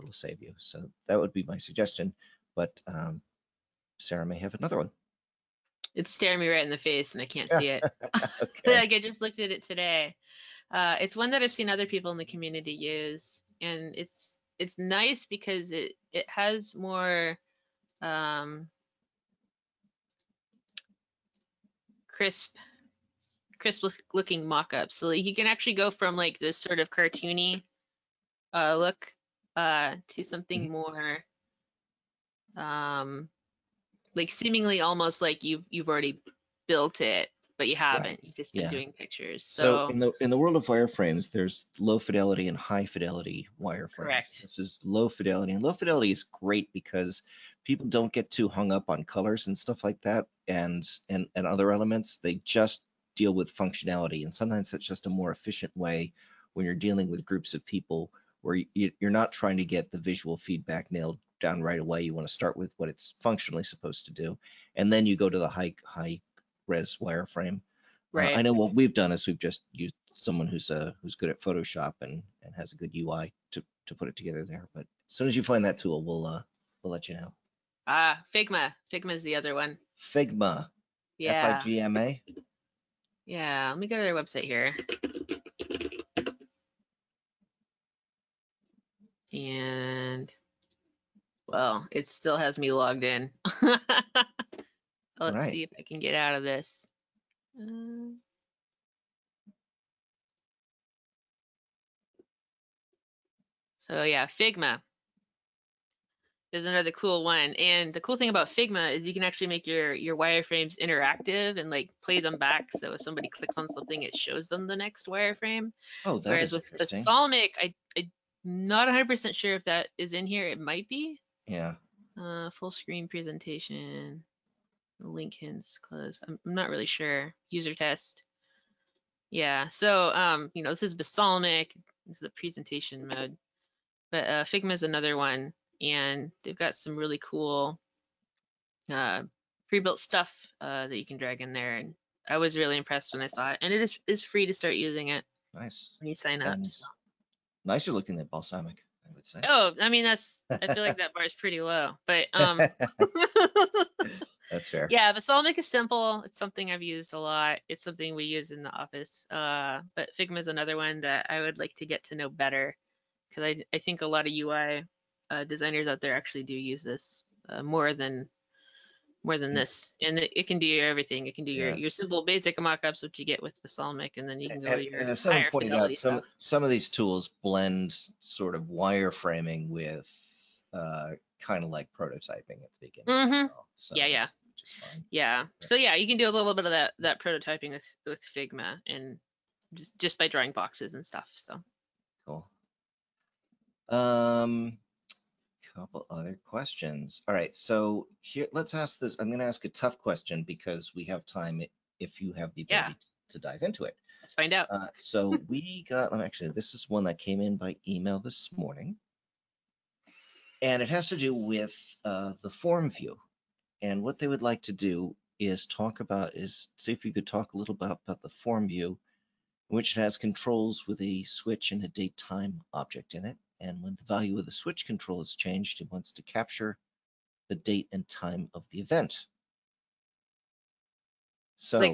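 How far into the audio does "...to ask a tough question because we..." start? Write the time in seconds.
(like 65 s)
199 s.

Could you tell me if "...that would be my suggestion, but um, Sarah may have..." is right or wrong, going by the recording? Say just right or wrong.
right.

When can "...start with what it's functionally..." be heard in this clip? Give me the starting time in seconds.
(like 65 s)
62 s.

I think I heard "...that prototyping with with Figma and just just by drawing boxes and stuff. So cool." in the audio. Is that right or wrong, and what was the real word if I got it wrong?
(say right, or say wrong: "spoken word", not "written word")
right.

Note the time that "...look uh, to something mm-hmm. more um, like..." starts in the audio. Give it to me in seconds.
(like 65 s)
28 s.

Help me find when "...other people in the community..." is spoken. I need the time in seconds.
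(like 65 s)
11 s.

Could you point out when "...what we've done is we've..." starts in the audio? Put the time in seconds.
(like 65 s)
68 s.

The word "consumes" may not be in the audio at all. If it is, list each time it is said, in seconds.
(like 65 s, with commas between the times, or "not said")
not said.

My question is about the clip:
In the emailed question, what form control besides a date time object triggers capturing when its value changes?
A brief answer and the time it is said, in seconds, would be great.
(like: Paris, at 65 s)
a switch, at 221 s.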